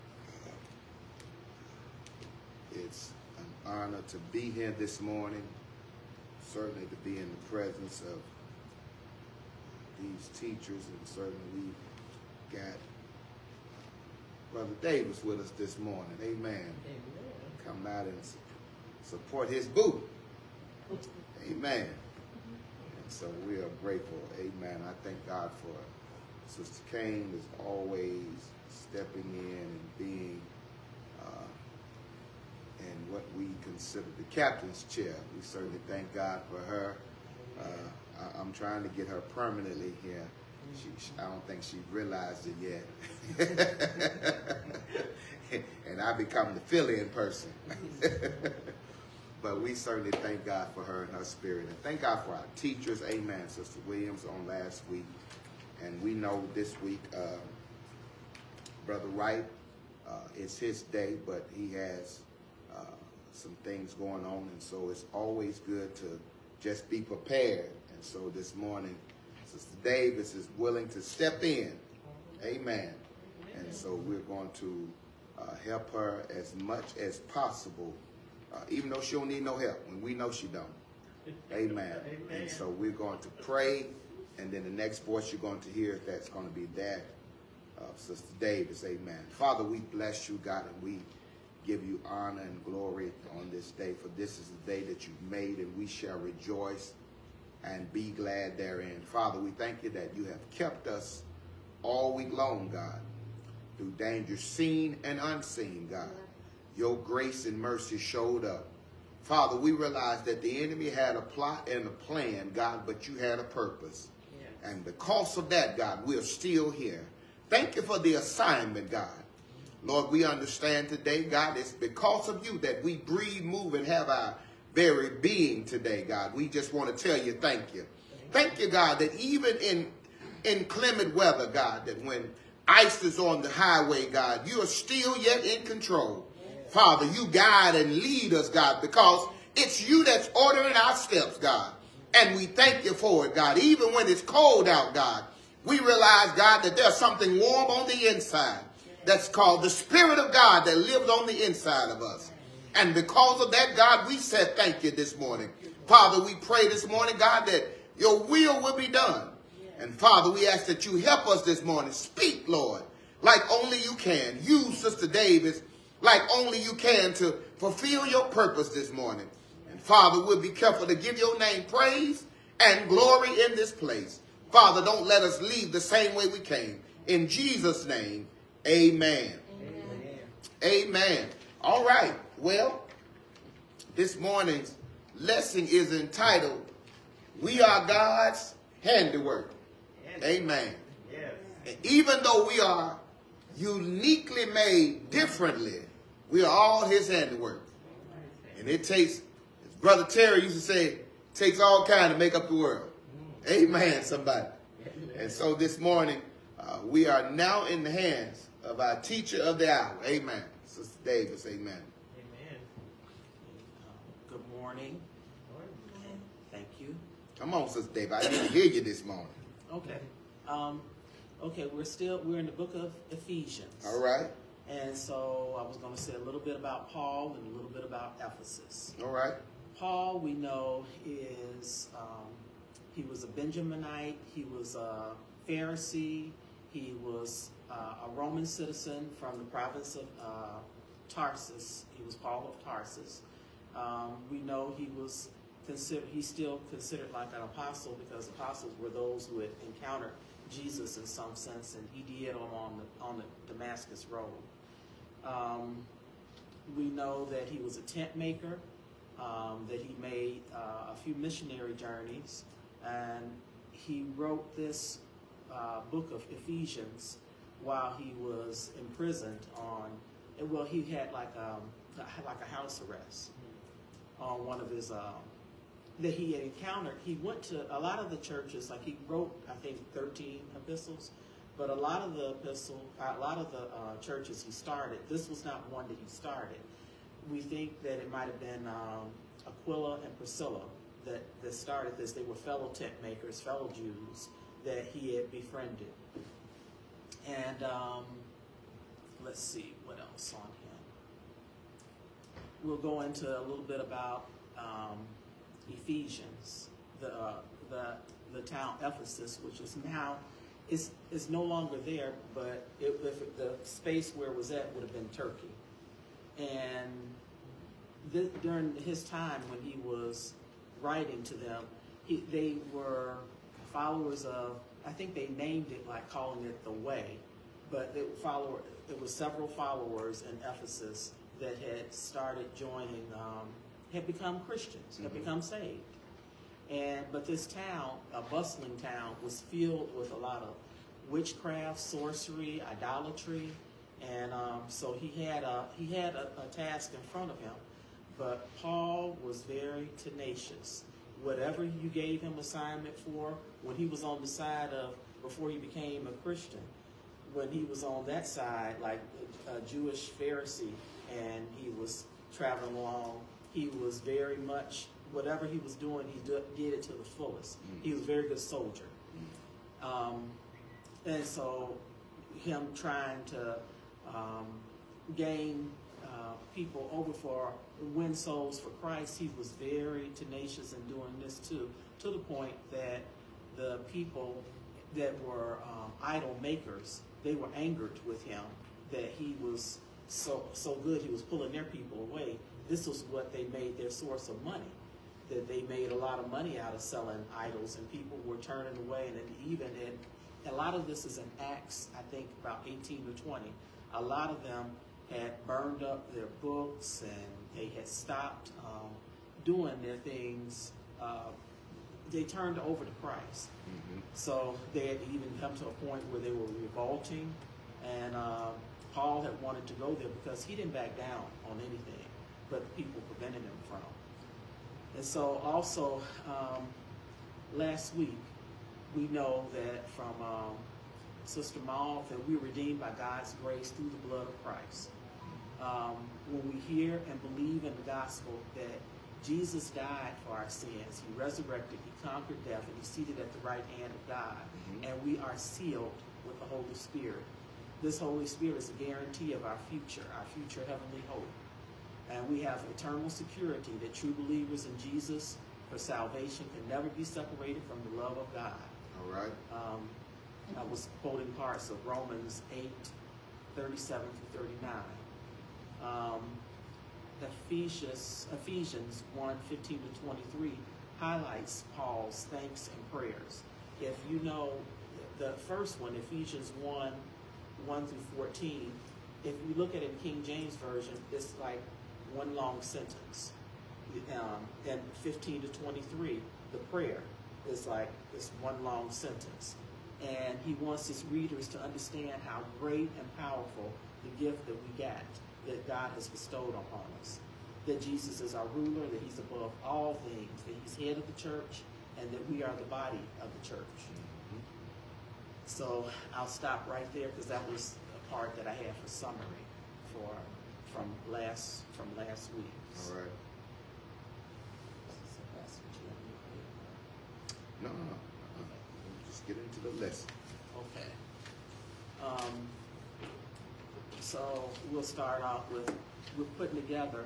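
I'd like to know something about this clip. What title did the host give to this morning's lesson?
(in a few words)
We Are God's Handiwork.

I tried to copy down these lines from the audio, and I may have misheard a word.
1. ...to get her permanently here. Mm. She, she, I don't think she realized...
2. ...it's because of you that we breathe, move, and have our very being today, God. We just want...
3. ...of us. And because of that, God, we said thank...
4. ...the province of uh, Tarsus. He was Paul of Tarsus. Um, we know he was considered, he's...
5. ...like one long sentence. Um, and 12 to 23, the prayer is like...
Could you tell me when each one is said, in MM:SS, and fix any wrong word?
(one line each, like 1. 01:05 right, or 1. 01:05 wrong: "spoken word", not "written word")
1. 00:38 right
2. 02:01 right
3. 02:31 right
4. 03:59 right
5. 08:01 wrong: "15", not "12".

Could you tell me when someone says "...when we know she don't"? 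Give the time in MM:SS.
01:19.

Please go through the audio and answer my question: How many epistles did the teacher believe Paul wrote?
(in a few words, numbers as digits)
13.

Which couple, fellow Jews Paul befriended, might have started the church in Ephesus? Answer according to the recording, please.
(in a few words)
Aquila and Priscilla.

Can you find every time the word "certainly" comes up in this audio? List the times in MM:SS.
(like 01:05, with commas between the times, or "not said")
00:06, 00:11, 00:35, 00:49.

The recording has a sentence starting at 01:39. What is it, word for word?
Father, we thank you that you have kept us all week long, God, through danger seen and unseen, God.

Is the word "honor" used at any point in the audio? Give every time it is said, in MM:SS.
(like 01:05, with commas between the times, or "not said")
00:03, 01:32.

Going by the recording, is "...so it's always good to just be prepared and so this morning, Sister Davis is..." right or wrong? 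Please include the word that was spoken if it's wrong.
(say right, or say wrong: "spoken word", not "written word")
right.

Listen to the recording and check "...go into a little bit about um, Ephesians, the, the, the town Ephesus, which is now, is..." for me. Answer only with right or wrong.
right.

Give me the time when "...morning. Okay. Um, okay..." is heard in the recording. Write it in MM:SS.
03:39.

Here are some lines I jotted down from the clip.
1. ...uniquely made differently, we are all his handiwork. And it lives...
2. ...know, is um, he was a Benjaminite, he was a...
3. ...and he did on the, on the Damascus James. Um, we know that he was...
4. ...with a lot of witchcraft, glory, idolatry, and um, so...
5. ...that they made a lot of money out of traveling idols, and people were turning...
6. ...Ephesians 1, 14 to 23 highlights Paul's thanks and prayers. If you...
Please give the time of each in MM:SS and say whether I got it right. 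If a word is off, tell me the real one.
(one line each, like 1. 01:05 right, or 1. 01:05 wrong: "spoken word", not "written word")
1. 03:13 wrong: "takes", not "lives"
2. 03:50 right
3. 04:11 wrong: "Road", not "James"
4. 05:39 wrong: "sorcery", not "glory"
5. 06:35 wrong: "selling", not "traveling"
6. 07:48 wrong: "15", not "14".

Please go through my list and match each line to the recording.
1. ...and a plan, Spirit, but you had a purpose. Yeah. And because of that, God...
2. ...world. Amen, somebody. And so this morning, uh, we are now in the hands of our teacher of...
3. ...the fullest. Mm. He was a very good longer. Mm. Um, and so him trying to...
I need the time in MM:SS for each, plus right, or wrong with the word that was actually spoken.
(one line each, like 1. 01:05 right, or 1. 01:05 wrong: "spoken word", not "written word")
1. 01:51 wrong: "God", not "Spirit"
2. 03:22 right
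3. 06:06 wrong: "soldier", not "longer".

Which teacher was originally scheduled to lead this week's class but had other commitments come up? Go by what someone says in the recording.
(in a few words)
Brother Wright.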